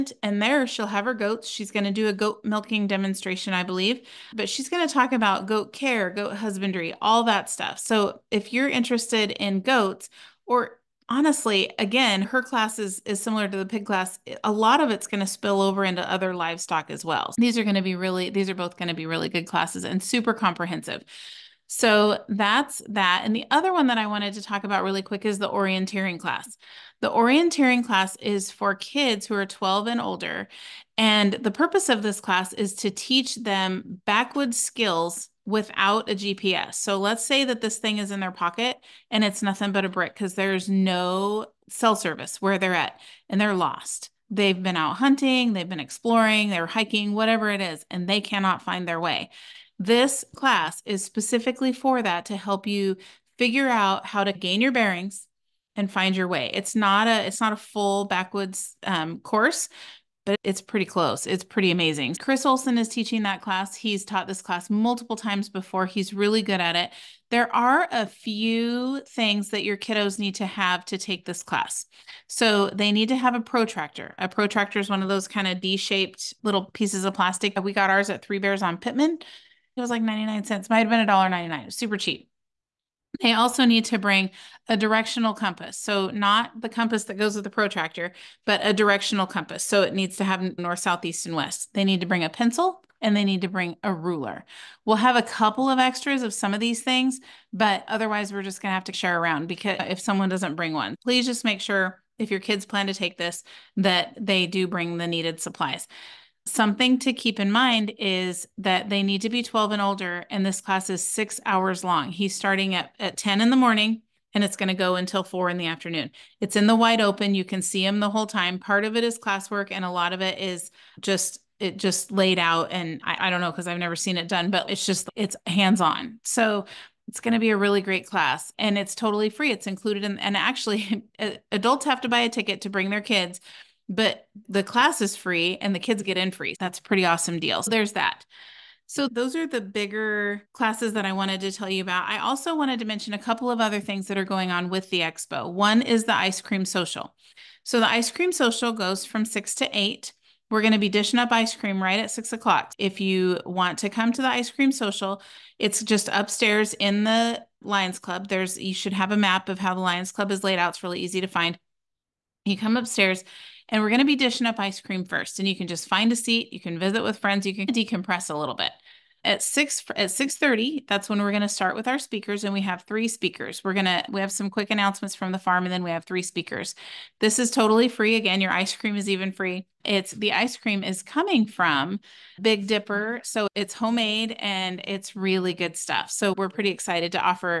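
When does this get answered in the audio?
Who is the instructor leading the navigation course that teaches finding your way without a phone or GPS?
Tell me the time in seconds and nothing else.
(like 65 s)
62 s.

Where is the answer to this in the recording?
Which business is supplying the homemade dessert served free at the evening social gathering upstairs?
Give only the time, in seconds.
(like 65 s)
182 s.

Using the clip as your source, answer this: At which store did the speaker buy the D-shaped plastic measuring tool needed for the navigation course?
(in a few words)
Three Bears.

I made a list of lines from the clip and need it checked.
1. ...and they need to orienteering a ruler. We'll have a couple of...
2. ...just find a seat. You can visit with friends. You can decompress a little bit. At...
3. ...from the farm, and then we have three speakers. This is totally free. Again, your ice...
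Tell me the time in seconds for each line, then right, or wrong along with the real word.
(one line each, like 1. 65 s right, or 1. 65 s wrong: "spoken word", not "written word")
1. 93 s wrong: "bring", not "orienteering"
2. 165 s right
3. 175 s right.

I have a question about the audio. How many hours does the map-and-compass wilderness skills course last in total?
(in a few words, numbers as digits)
6.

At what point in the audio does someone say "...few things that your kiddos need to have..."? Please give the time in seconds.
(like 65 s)
68 s.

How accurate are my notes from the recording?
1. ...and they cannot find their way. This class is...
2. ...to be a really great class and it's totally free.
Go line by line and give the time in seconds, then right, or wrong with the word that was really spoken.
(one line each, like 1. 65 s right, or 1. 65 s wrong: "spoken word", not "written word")
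1. 47 s right
2. 127 s right.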